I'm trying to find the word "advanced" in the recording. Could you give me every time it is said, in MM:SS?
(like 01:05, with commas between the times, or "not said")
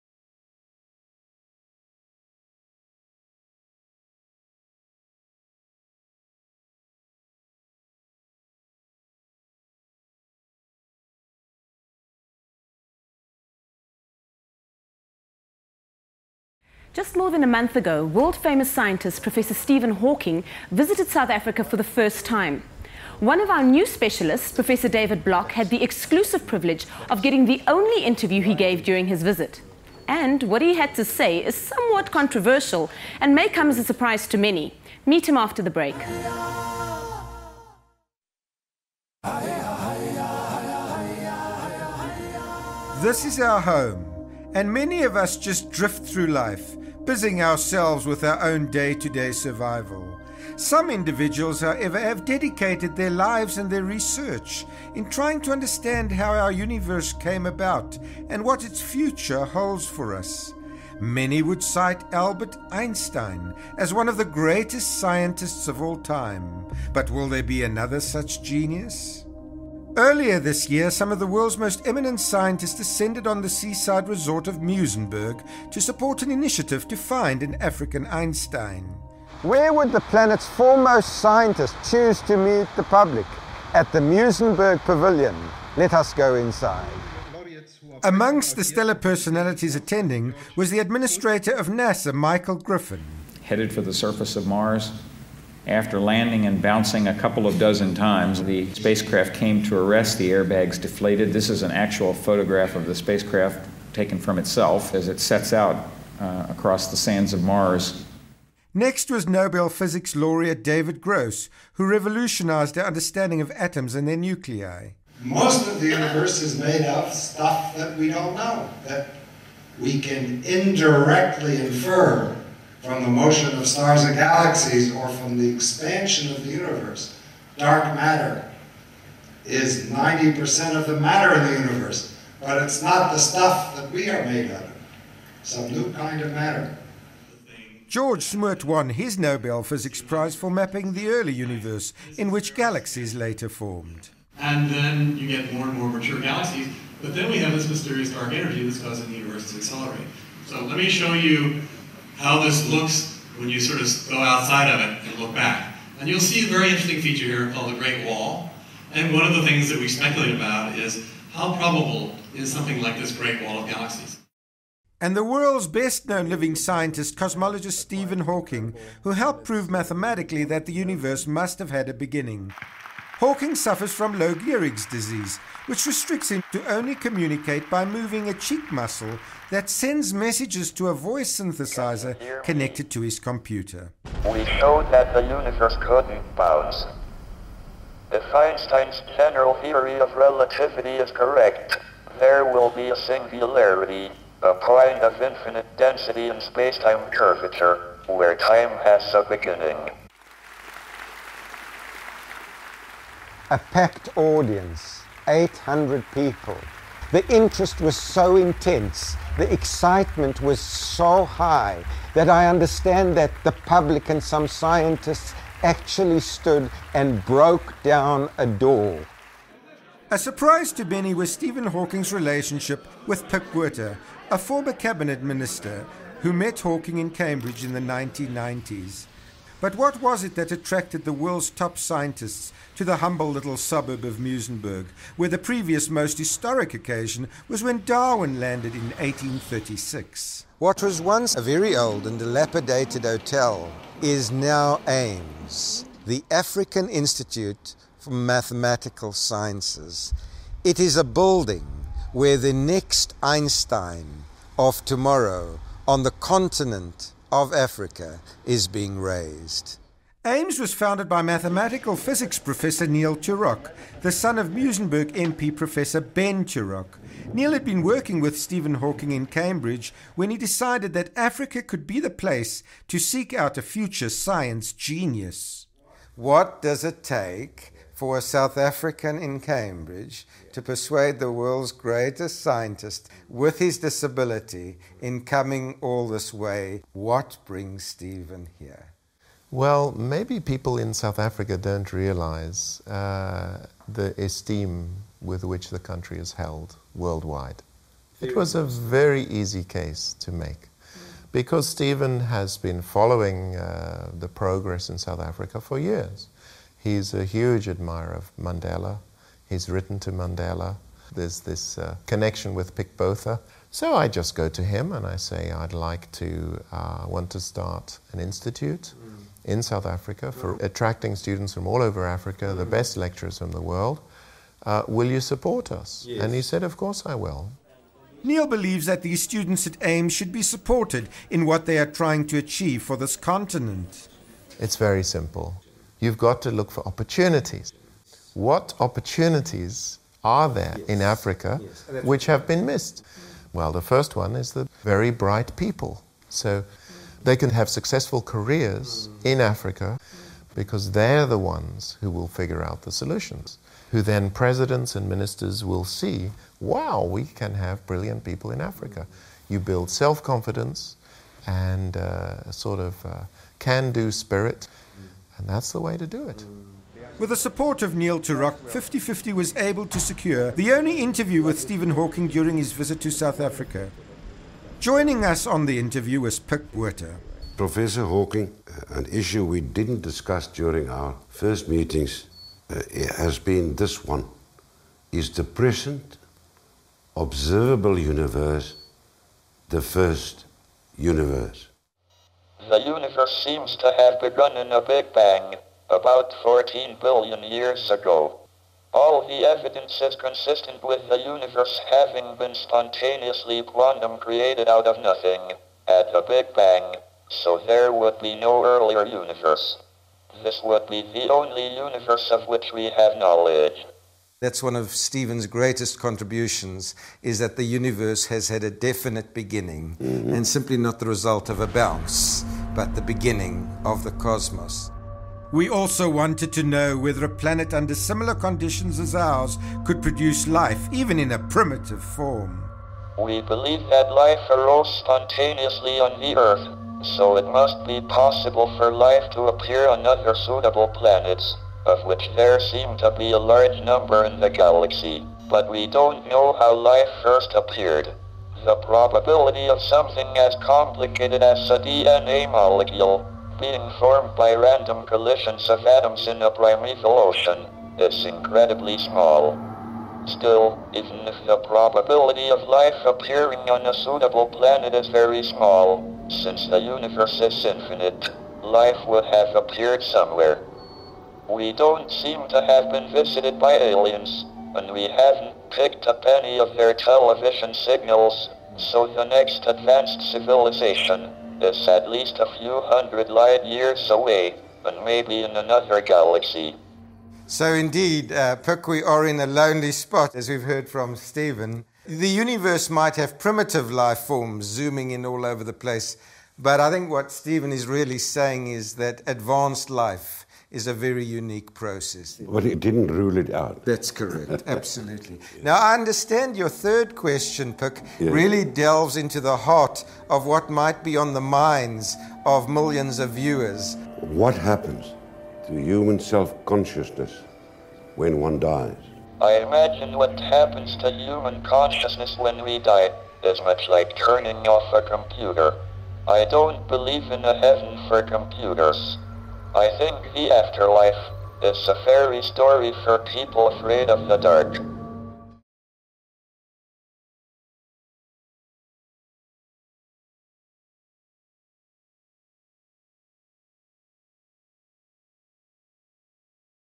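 07:59, 08:19.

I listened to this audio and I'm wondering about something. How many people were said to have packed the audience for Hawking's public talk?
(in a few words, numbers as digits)
800.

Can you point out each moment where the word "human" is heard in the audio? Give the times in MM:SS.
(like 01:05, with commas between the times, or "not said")
08:35, 08:41.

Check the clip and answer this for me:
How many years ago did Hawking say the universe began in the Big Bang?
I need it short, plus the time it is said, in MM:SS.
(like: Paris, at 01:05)
14 billion, at 06:36.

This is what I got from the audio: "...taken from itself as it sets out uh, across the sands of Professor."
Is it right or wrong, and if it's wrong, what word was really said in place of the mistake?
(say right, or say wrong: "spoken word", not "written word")
wrong: "Mars", not "Professor".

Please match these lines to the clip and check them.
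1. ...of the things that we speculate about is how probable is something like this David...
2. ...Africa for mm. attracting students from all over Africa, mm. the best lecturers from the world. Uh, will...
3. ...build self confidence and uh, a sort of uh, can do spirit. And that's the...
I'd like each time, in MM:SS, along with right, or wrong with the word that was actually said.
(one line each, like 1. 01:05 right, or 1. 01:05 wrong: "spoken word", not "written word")
1. 02:39 wrong: "Great", not "David"
2. 05:19 right
3. 05:59 right.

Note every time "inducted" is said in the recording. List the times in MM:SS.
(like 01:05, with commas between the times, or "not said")
not said.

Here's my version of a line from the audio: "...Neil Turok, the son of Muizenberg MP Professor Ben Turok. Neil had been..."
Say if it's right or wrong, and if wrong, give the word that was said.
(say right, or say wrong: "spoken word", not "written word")
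right.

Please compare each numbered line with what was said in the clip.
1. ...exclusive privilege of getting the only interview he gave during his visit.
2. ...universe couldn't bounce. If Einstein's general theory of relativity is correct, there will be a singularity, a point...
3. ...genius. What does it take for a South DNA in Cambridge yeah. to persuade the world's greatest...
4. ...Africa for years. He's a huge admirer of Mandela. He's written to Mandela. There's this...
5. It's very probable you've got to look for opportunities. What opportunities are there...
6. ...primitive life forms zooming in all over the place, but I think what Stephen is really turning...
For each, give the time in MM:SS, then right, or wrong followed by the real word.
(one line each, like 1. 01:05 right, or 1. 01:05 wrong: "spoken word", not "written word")
1. 00:25 right
2. 03:05 right
3. 04:34 wrong: "African", not "DNA"
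4. 05:05 right
5. 05:34 wrong: "simple", not "probable"
6. 08:13 wrong: "saying", not "turning".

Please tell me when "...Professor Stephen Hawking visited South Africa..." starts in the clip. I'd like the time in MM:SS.
00:19.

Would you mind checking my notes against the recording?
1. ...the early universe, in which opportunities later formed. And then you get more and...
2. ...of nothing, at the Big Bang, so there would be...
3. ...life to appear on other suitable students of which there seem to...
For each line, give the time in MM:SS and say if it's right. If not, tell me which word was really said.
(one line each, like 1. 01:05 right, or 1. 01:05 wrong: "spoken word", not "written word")
1. 02:20 wrong: "galaxies", not "opportunities"
2. 06:44 right
3. 07:18 wrong: "planets", not "students".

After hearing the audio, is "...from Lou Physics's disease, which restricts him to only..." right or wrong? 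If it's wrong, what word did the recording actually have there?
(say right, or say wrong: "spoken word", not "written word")
wrong: "Gehrig", not "Physics".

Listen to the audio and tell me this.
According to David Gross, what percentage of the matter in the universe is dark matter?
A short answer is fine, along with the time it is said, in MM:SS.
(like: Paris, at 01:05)
90%, at 02:09.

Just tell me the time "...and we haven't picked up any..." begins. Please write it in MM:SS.
07:54.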